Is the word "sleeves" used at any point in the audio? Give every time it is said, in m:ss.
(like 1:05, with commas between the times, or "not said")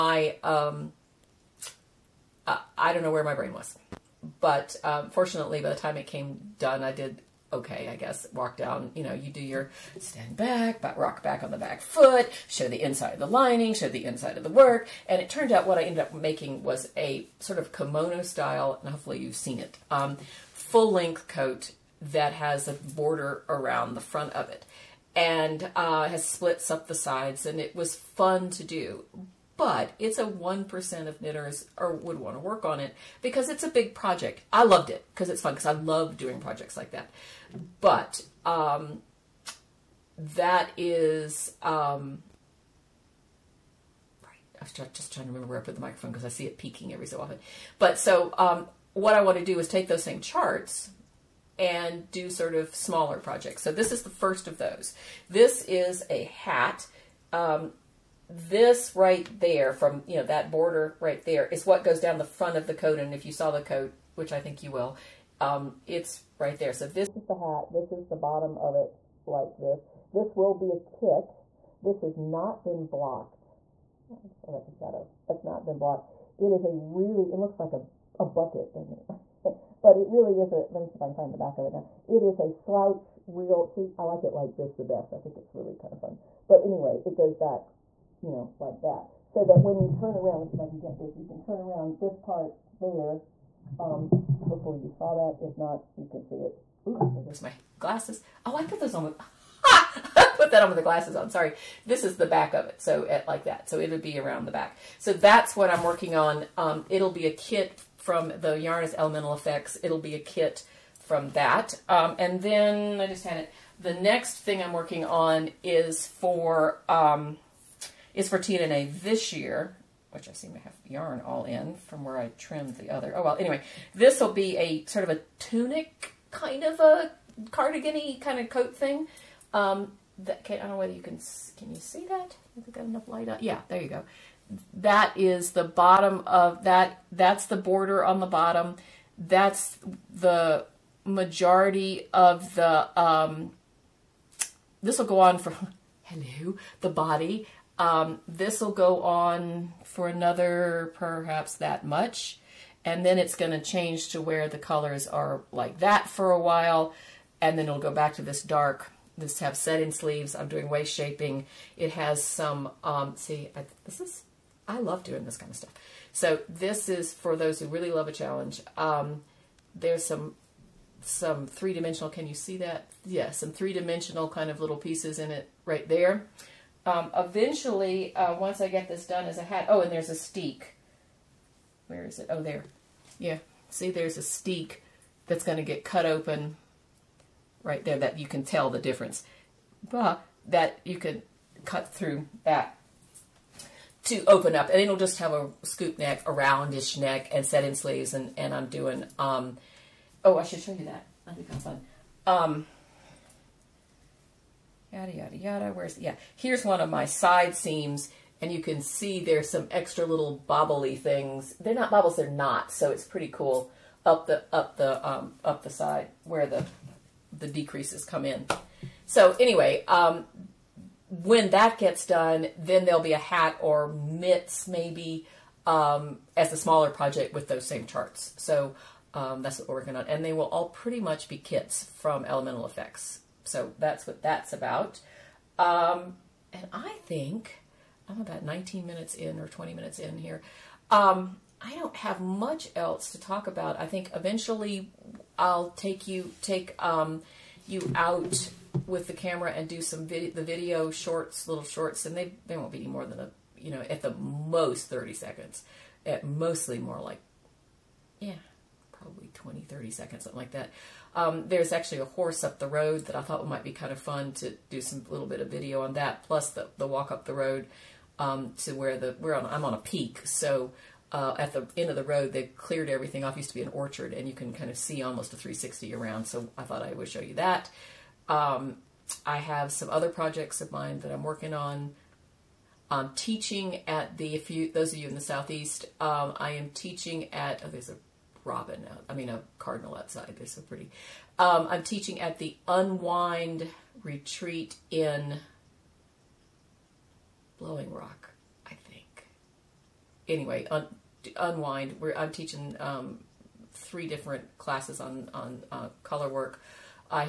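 2:39, 3:17.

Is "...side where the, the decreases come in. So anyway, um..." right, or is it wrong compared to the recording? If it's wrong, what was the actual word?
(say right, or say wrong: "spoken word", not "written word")
right.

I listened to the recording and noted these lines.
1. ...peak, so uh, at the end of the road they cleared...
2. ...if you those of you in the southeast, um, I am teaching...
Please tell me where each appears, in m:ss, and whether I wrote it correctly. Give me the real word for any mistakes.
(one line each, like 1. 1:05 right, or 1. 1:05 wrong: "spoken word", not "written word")
1. 4:29 right
2. 4:44 right.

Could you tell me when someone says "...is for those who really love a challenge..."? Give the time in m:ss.
2:46.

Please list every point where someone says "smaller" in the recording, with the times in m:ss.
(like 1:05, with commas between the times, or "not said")
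0:52, 3:46.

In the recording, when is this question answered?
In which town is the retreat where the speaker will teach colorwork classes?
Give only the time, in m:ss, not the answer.
4:57.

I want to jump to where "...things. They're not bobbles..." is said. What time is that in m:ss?
3:30.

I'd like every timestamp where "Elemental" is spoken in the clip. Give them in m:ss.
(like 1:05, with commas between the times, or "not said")
1:48, 3:52.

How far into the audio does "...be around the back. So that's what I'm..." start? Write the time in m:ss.
1:44.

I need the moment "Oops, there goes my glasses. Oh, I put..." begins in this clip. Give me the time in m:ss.
1:36.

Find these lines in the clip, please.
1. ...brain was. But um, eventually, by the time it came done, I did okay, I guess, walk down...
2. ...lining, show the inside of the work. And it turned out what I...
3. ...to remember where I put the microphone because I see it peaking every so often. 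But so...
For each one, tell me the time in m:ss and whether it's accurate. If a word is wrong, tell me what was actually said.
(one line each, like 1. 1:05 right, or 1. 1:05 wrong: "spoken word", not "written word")
1. 0:03 wrong: "fortunately", not "eventually"
2. 0:13 right
3. 0:45 right.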